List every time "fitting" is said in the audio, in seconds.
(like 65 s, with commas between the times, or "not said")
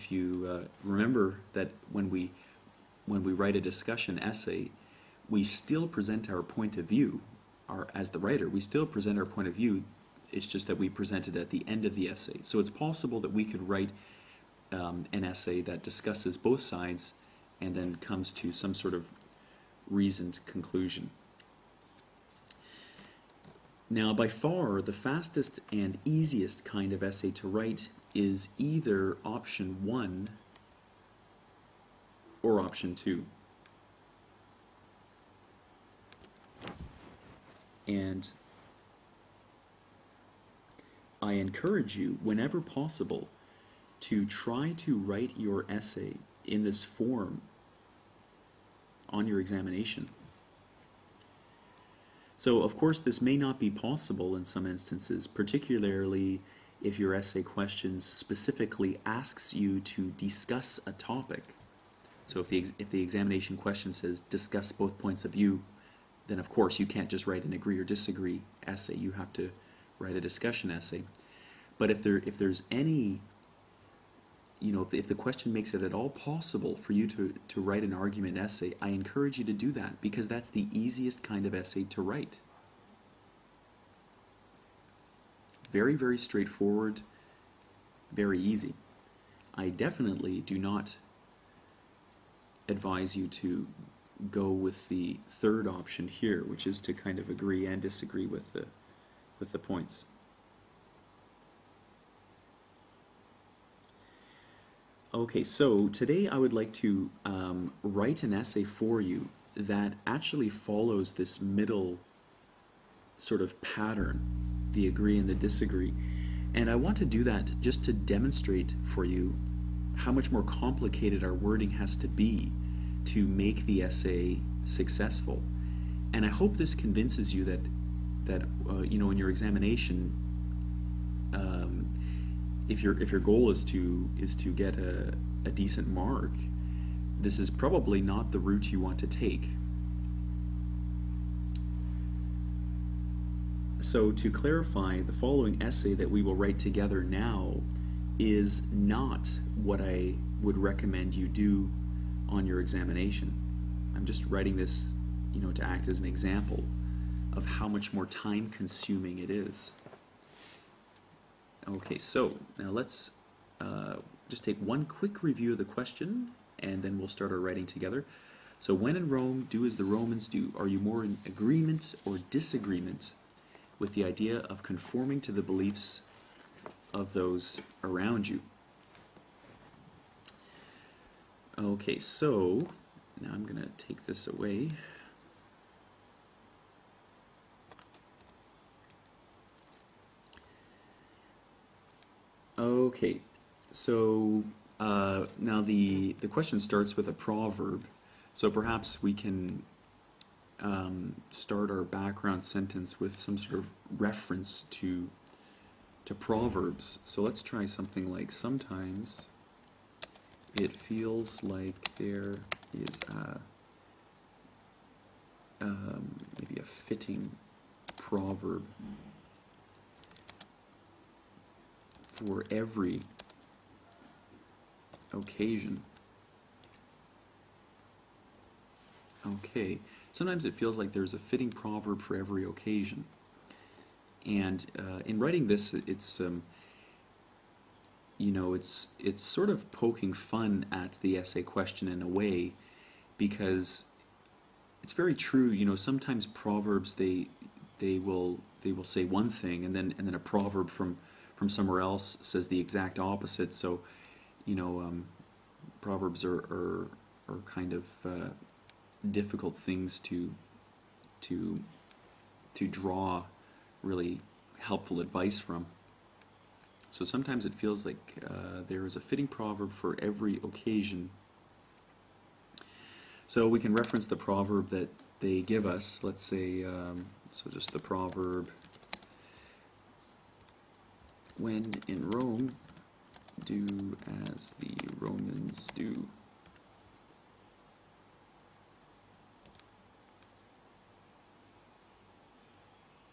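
216 s, 231 s, 268 s.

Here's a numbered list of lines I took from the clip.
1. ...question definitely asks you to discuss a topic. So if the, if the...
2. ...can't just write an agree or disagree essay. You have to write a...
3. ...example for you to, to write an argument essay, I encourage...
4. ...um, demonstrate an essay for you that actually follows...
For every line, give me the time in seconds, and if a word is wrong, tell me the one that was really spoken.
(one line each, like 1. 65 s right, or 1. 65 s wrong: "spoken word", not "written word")
1. 57 s wrong: "specifically", not "definitely"
2. 66 s right
3. 76 s wrong: "possible", not "example"
4. 107 s wrong: "write", not "demonstrate".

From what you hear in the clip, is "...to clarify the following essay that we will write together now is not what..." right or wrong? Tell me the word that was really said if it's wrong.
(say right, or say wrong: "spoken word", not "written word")
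right.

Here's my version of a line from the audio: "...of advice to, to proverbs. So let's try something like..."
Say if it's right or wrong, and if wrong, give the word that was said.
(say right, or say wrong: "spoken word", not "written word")
wrong: "reference", not "advice".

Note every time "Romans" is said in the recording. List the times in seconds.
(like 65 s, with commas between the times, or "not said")
169 s, 284 s.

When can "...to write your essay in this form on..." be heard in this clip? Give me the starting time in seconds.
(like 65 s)
44 s.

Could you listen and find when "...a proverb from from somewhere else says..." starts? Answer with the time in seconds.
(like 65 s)
250 s.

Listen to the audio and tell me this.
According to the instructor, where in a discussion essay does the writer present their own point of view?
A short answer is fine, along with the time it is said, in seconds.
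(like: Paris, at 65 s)
at the end, at 11 s.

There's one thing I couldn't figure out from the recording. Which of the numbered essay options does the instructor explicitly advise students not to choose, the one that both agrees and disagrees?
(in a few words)
the third option.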